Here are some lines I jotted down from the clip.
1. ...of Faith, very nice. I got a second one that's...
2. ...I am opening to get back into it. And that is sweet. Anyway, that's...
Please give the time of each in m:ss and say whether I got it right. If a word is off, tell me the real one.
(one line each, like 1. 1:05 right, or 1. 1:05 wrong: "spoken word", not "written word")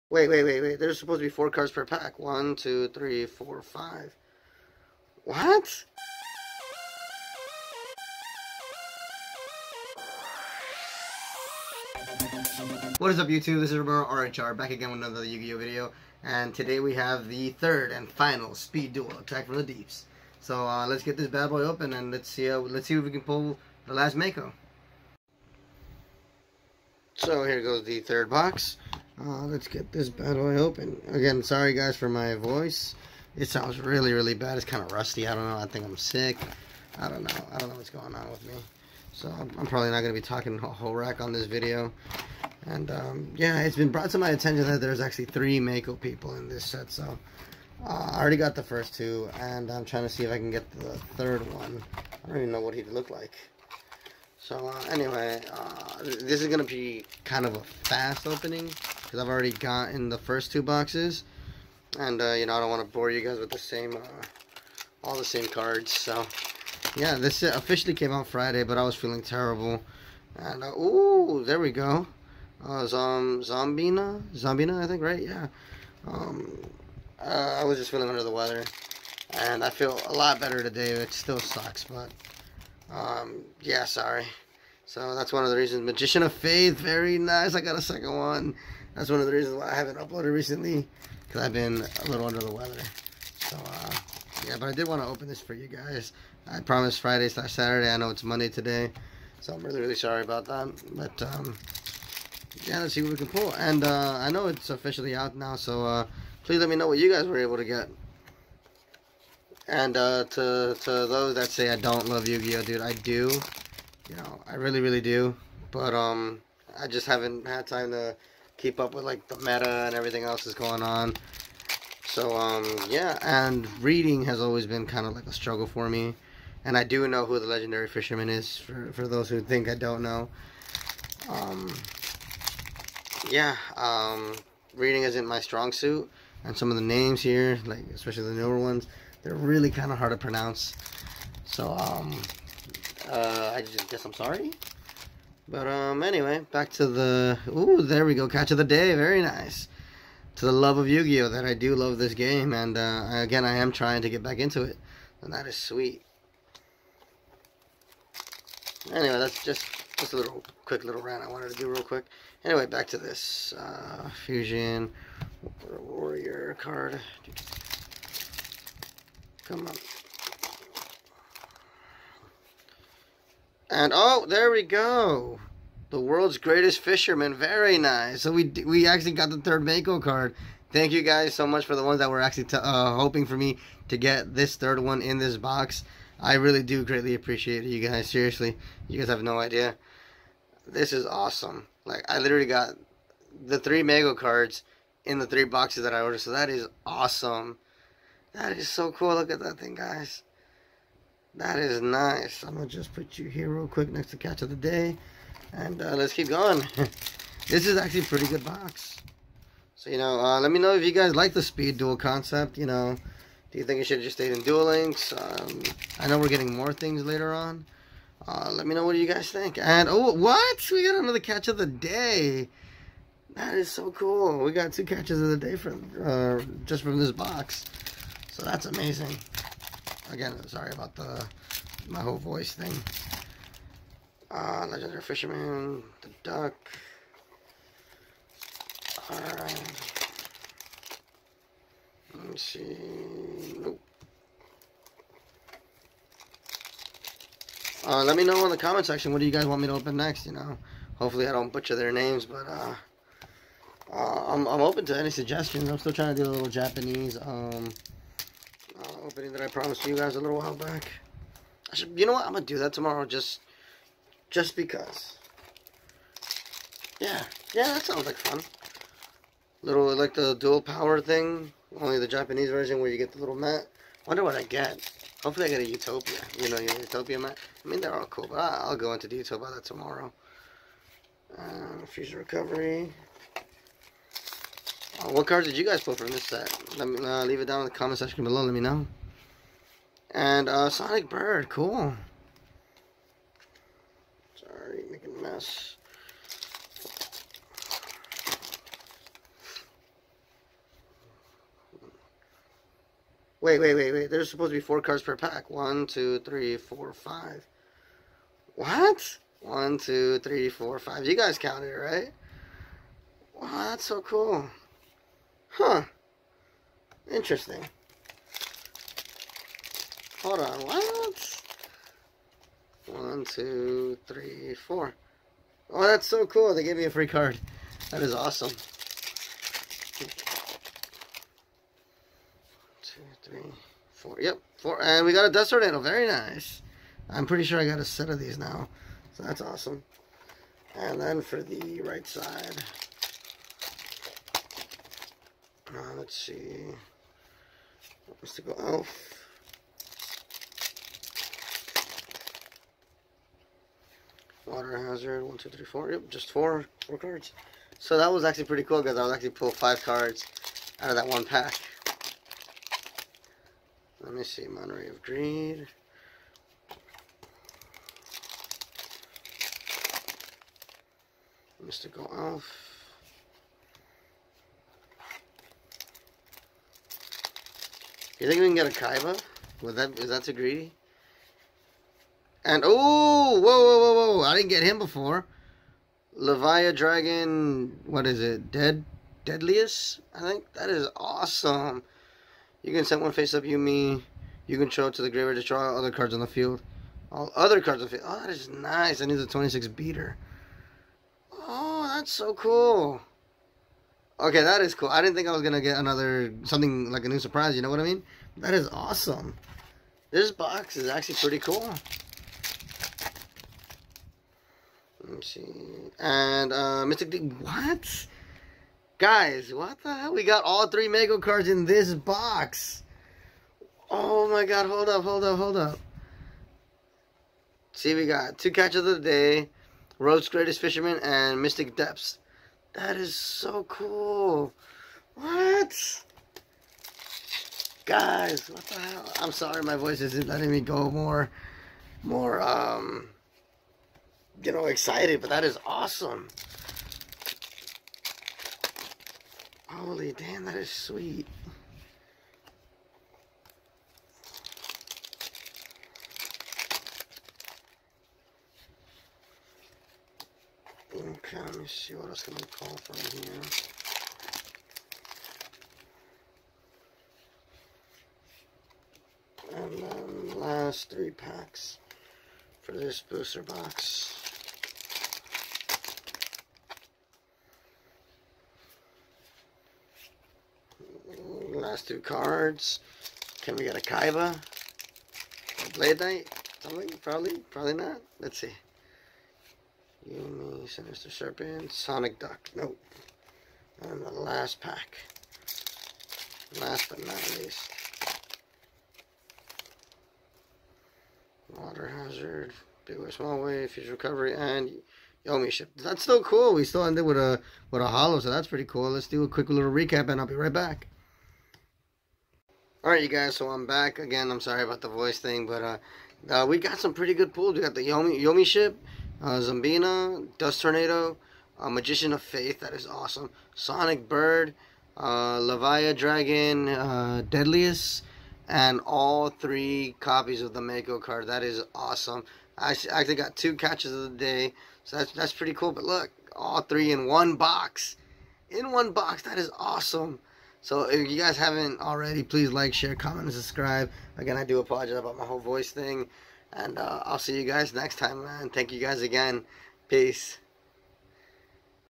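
1. 1:26 right
2. 2:33 wrong: "trying", not "opening".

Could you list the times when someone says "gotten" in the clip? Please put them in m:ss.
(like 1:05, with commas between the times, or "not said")
0:59.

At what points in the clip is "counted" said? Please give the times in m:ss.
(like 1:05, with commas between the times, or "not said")
5:11.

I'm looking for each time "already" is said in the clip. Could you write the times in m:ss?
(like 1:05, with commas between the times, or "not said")
0:48, 0:59, 9:01.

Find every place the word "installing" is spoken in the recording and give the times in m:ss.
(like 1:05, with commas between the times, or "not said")
not said.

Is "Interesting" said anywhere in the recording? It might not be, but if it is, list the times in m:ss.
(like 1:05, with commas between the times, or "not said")
5:17.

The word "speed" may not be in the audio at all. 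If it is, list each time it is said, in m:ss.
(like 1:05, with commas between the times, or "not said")
0:18, 3:31.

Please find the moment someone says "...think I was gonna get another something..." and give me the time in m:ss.
6:45.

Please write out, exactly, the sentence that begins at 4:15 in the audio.
I'm still trying to do a little Japanese um, opening that I promised you guys a little while back.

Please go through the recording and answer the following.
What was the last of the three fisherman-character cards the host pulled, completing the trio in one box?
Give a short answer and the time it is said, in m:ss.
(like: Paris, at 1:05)
Mystic Depths, at 7:11.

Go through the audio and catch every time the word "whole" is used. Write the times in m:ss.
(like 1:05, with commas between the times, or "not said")
0:40, 3:52, 9:05.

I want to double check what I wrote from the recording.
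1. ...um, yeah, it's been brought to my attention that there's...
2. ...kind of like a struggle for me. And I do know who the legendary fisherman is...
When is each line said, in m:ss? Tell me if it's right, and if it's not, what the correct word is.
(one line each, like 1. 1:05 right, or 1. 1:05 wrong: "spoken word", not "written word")
1. 0:42 right
2. 2:04 right.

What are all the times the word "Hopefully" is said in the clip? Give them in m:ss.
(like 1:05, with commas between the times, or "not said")
4:10, 4:35.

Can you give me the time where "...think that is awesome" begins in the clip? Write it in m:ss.
6:30.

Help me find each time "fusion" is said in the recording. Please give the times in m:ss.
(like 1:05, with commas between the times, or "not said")
2:44, 4:41, 8:23.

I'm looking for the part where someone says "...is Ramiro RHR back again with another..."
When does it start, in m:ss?
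0:13.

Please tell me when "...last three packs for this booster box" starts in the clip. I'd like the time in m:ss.
7:50.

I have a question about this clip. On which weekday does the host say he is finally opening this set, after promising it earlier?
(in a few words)
Monday.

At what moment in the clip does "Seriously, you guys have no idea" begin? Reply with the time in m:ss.
3:08.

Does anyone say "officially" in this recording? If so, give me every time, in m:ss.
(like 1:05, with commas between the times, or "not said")
1:07, 1:44.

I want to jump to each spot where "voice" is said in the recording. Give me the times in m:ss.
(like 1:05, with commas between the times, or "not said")
0:32, 3:52, 7:19, 8:34, 9:05.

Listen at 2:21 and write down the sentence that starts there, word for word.
So um uh I just guess I'm sorry.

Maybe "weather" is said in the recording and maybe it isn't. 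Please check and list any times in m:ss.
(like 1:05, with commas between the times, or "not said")
1:18, 1:32.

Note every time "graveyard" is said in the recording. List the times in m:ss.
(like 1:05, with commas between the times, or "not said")
6:35.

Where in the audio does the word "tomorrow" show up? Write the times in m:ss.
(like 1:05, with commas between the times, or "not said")
4:22, 4:39.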